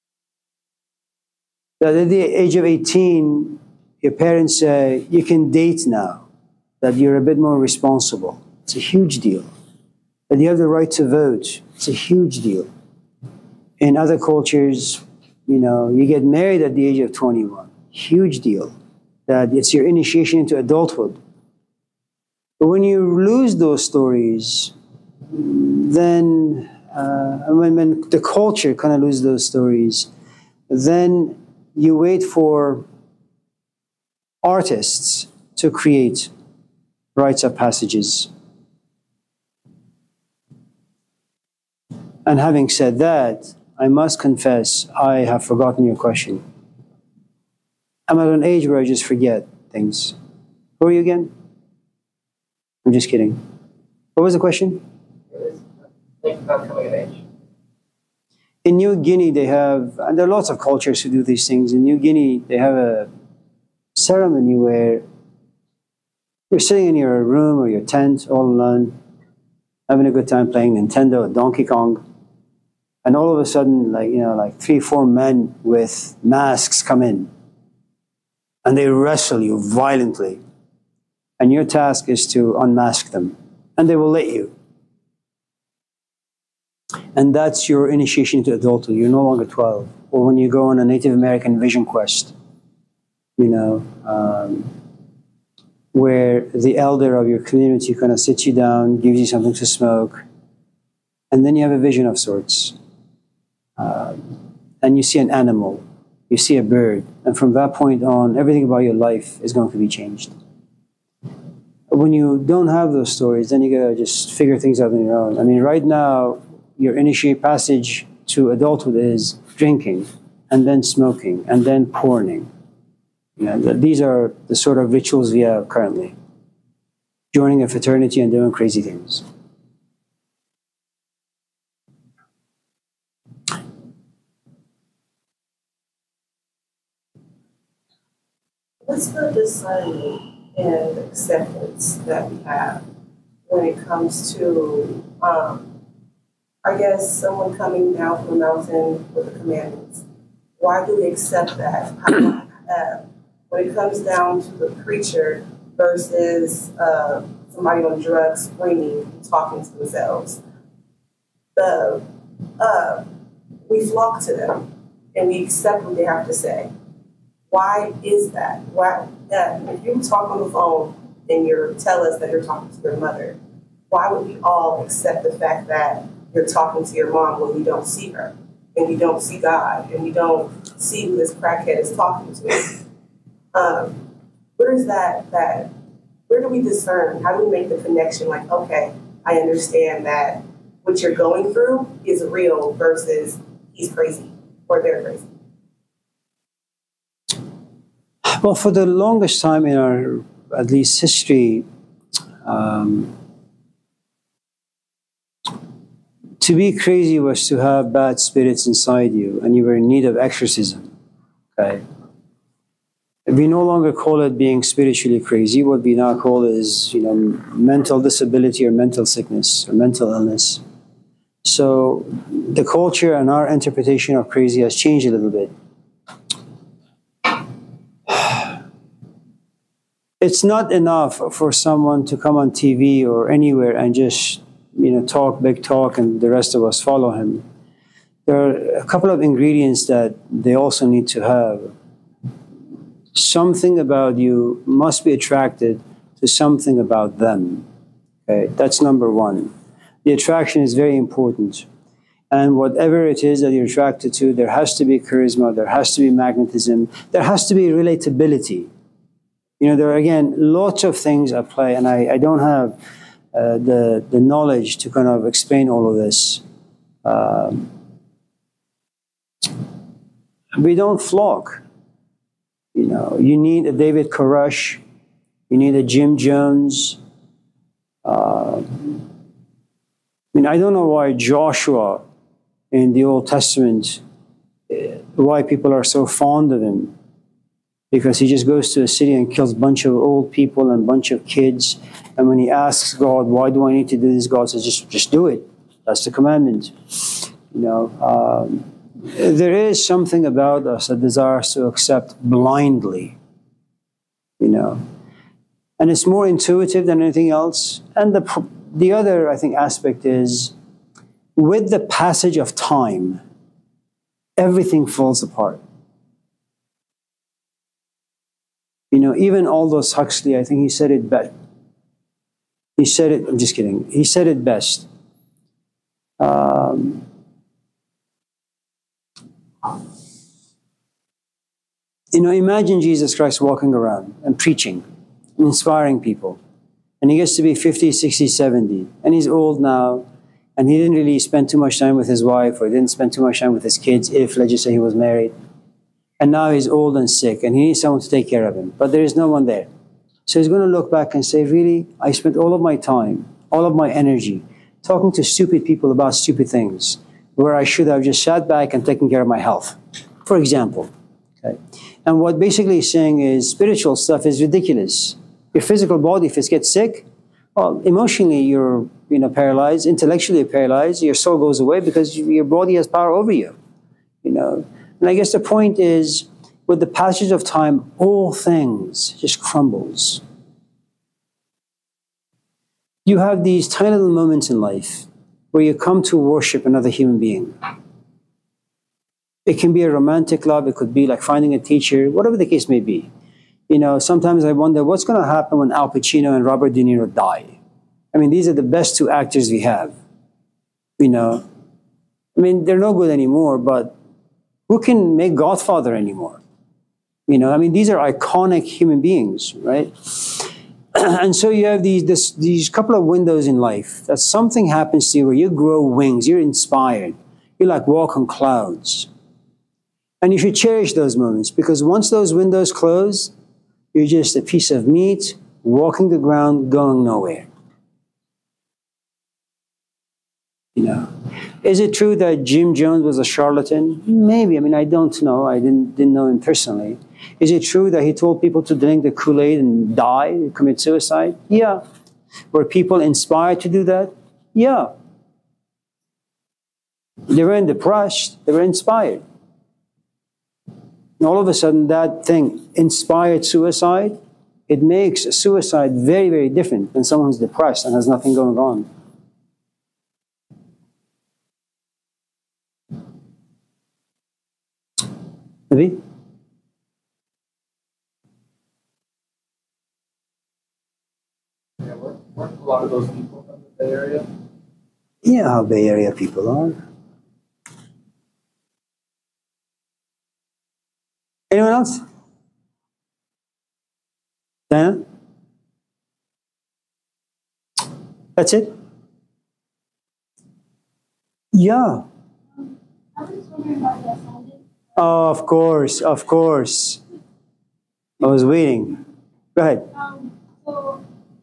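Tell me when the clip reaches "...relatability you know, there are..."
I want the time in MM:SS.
04:17.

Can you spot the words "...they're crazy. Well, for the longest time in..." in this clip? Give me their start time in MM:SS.
03:14.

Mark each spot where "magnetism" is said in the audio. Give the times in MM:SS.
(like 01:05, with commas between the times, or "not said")
04:16.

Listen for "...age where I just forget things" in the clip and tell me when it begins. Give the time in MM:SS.
00:48.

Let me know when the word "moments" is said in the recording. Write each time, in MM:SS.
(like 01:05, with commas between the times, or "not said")
06:24, 07:01.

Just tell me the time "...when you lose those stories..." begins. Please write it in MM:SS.
00:22.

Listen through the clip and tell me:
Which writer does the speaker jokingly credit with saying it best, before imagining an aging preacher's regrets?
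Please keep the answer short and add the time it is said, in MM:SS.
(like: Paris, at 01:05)
Aldous Huxley, at 05:19.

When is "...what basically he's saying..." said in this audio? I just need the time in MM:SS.
06:02.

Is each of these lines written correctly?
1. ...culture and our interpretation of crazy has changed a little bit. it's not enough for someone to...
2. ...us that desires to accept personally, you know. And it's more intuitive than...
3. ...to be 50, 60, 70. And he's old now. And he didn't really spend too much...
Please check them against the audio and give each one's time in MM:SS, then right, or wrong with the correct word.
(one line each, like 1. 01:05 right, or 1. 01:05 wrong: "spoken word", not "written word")
1. 03:42 right
2. 05:00 wrong: "blindly", not "personally"
3. 05:37 right.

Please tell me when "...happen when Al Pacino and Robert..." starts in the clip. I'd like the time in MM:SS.
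06:35.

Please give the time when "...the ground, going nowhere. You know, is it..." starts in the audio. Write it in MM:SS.
07:06.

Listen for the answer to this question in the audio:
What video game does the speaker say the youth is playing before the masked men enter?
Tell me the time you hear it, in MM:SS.
01:11.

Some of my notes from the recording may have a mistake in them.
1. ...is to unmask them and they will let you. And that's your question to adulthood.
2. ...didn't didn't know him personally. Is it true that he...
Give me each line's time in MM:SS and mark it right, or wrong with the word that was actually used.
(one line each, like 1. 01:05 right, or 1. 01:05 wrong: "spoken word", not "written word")
1. 01:22 wrong: "initiation", not "question"
2. 07:15 right.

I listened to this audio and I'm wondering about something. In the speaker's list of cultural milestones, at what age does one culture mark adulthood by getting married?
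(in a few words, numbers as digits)
21.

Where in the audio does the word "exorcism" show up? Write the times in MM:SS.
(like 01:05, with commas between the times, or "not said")
03:30.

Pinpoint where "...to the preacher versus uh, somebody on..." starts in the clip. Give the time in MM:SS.
02:34.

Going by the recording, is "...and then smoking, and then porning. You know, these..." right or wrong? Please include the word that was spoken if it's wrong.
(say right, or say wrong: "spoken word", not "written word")
right.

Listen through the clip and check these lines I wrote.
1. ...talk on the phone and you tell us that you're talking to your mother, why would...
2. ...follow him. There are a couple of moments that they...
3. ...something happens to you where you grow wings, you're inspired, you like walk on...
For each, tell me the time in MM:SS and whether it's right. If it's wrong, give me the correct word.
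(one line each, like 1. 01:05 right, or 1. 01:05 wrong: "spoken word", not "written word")
1. 02:50 right
2. 03:56 wrong: "ingredients", not "moments"
3. 06:54 right.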